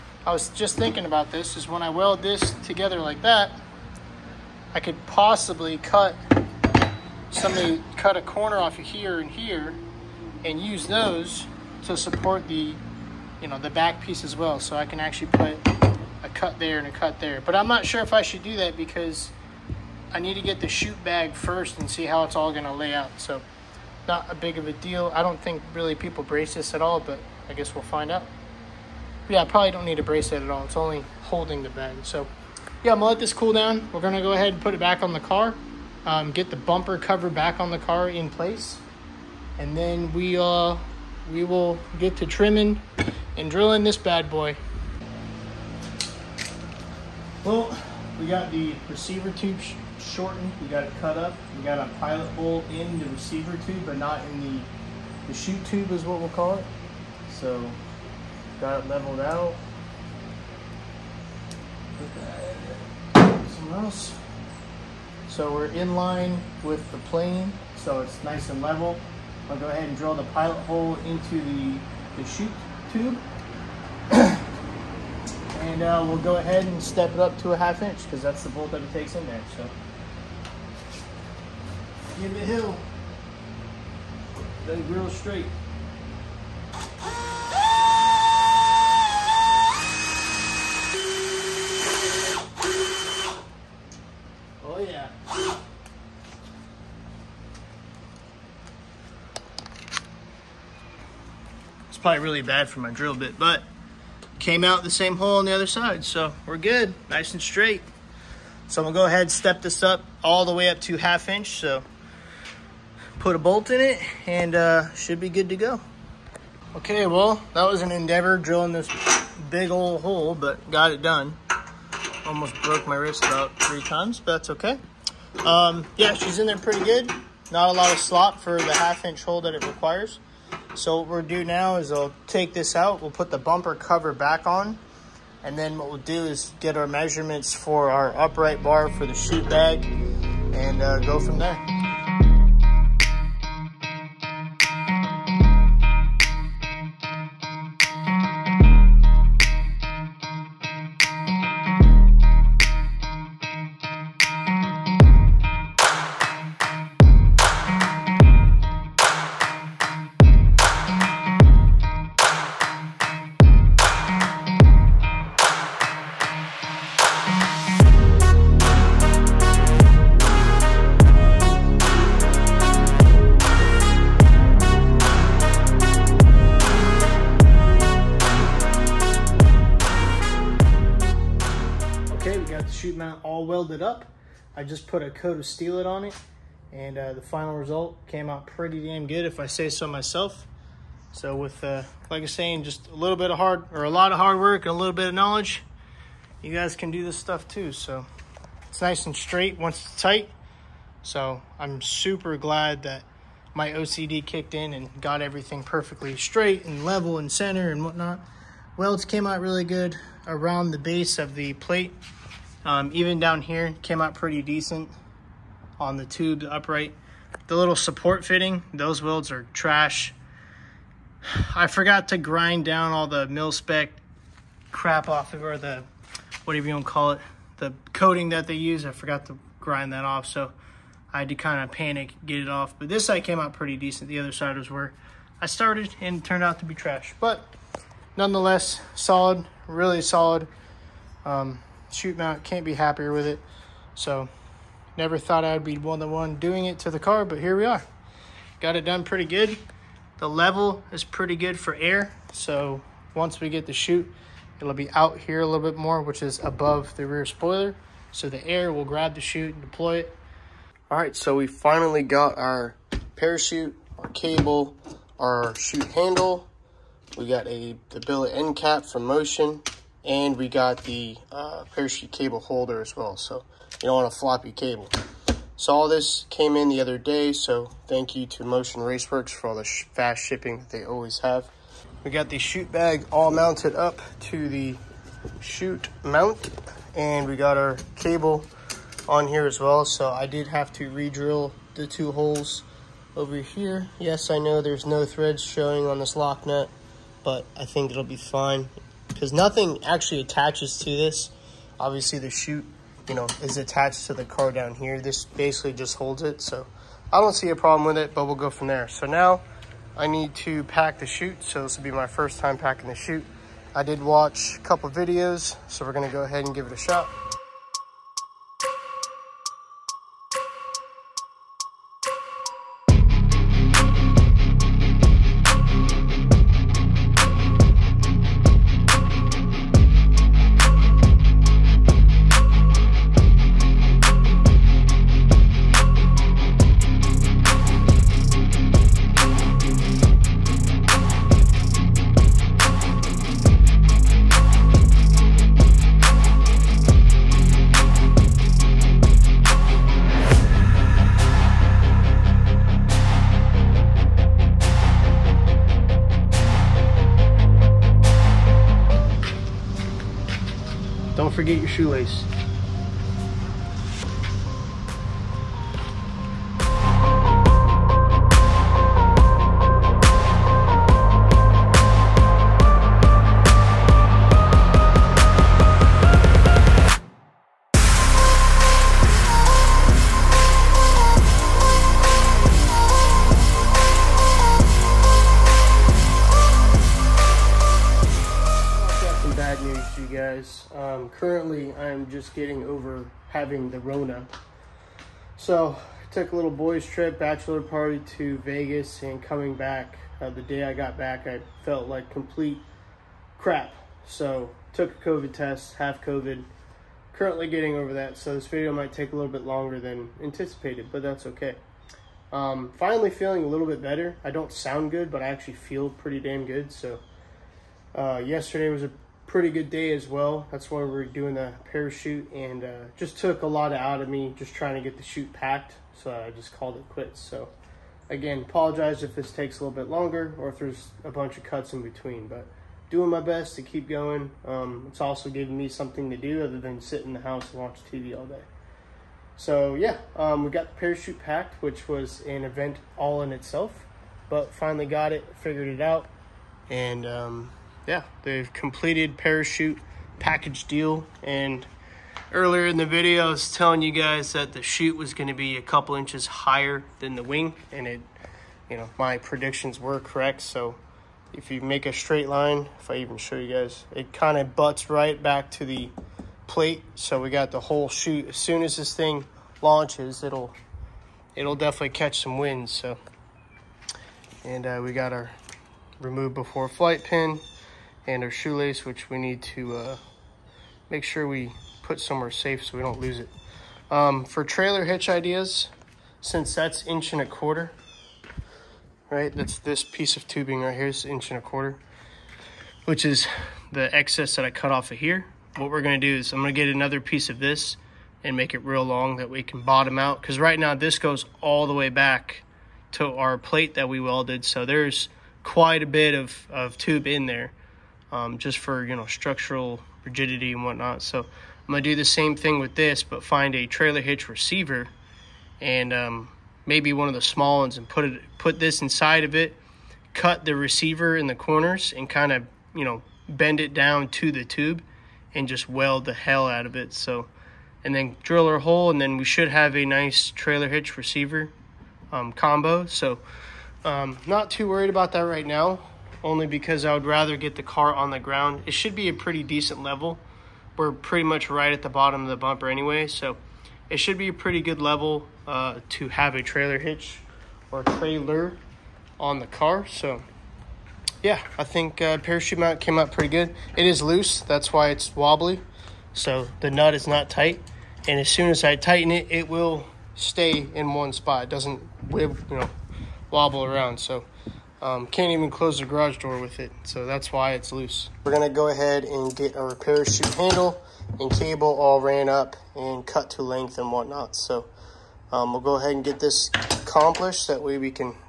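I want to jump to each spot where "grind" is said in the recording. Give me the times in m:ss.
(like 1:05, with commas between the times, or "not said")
3:42, 3:49.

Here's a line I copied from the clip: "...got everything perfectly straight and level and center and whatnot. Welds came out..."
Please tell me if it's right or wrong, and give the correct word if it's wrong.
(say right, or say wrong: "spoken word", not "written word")
right.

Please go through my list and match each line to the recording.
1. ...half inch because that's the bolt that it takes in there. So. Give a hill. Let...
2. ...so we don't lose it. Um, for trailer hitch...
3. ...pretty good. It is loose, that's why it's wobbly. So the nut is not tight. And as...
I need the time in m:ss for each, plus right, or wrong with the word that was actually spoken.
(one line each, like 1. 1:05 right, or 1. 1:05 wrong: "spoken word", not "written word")
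1. 1:17 right
2. 8:02 right
3. 9:13 right.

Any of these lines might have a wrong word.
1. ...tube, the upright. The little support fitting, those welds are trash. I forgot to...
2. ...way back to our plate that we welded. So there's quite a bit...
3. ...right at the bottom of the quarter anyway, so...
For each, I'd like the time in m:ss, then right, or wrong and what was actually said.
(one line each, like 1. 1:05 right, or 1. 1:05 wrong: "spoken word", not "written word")
1. 3:36 right
2. 8:21 right
3. 9:01 wrong: "bumper", not "quarter".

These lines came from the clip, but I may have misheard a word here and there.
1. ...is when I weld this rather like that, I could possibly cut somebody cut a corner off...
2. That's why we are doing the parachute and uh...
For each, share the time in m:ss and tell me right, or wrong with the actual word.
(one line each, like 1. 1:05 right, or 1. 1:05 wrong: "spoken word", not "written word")
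1. 0:01 wrong: "together", not "rather"
2. 7:00 right.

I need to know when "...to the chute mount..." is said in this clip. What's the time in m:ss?
4:44.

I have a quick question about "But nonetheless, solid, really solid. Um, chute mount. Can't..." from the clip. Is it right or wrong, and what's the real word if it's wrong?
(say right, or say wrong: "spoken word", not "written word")
right.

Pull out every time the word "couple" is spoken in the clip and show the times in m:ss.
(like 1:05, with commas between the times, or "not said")
5:14, 7:35.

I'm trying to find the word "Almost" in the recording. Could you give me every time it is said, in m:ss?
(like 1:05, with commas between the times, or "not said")
2:02.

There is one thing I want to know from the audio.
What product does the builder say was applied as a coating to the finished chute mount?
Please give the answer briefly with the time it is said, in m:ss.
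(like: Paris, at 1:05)
Steel-It, at 3:05.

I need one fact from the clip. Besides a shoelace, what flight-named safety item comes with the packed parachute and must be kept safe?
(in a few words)
remove before flight pin.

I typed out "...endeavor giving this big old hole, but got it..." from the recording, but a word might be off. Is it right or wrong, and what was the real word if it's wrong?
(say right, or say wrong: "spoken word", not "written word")
wrong: "drilling", not "giving".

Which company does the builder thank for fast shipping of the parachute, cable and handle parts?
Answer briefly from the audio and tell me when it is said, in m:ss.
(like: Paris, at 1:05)
Motion Raceworks, at 4:38.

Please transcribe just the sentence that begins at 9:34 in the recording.
So um, we'll go ahead and get this accomplished.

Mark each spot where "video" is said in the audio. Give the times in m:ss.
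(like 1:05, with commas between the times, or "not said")
5:14, 6:48, 7:32.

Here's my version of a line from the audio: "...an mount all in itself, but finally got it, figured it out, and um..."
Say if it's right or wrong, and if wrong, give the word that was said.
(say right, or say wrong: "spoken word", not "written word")
wrong: "event", not "mount".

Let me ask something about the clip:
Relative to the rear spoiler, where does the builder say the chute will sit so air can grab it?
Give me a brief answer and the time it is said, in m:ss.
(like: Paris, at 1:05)
above the rear spoiler, at 4:16.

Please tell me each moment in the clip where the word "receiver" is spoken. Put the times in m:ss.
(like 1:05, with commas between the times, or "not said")
0:48, 0:53, 8:34, 8:40, 8:50.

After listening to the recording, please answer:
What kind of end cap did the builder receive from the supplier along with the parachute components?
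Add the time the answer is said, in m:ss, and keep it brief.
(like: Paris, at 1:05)
billet end cap, at 4:28.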